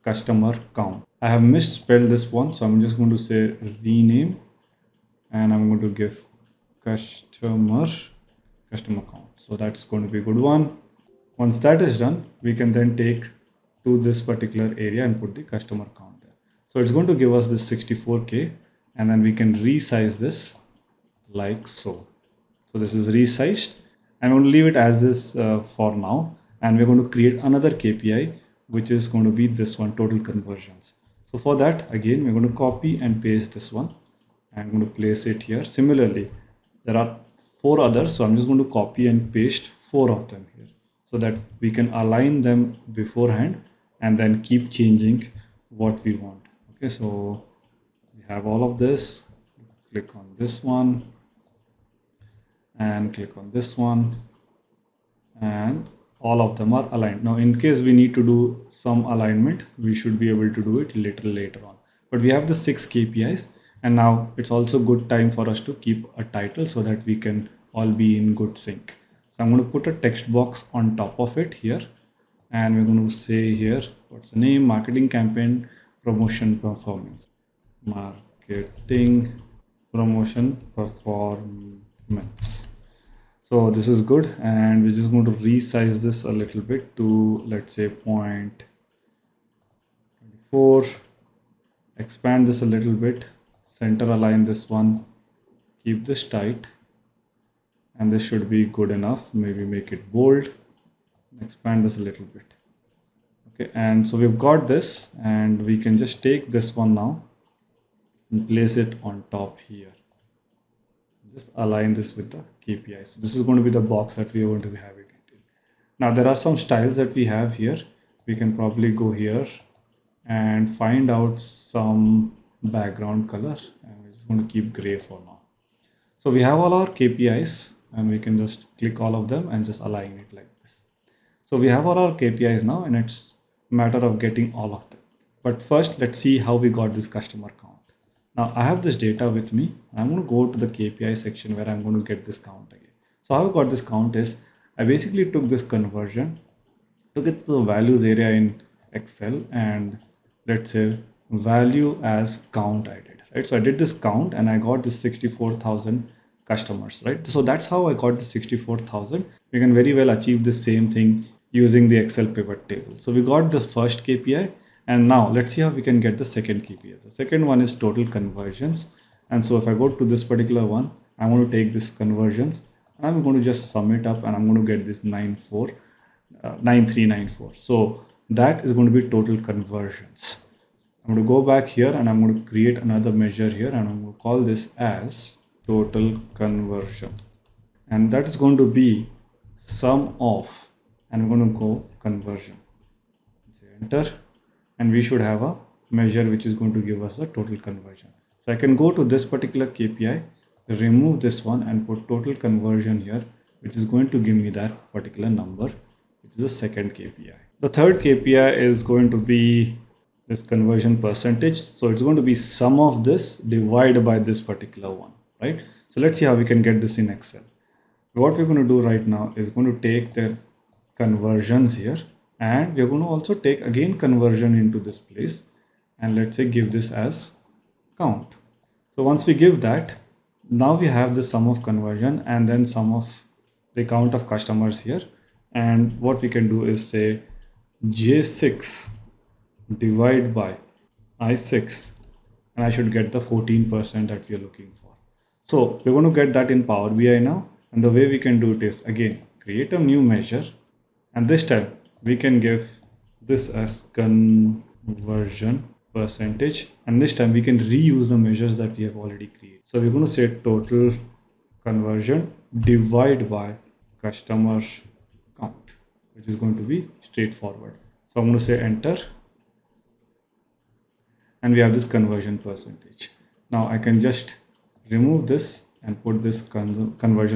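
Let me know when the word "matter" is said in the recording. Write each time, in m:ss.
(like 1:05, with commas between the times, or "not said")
2:13.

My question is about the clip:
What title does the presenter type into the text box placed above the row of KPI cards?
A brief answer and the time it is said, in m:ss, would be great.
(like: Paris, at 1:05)
Marketing promotion performance, at 1:17.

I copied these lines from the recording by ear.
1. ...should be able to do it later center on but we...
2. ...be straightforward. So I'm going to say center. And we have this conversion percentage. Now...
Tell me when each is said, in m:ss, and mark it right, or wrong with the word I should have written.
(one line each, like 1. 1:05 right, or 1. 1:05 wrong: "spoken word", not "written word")
1. 0:59 wrong: "later", not "center"
2. 4:26 wrong: "enter", not "center".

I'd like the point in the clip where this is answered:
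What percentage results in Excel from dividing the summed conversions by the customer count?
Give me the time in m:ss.
4:03.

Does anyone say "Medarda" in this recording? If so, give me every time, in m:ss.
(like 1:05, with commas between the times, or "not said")
not said.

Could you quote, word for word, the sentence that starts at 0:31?
So for that, again, we're going to copy and paste this one.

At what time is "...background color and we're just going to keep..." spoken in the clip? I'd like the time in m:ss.
2:02.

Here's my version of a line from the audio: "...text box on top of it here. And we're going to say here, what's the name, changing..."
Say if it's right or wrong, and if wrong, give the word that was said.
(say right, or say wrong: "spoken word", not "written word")
wrong: "marketing", not "changing".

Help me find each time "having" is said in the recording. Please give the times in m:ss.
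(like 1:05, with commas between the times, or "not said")
1:54.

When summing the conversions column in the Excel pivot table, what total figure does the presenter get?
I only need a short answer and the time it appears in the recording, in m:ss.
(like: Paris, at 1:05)
9394, at 2:56.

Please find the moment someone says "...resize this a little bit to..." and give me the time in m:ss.
1:25.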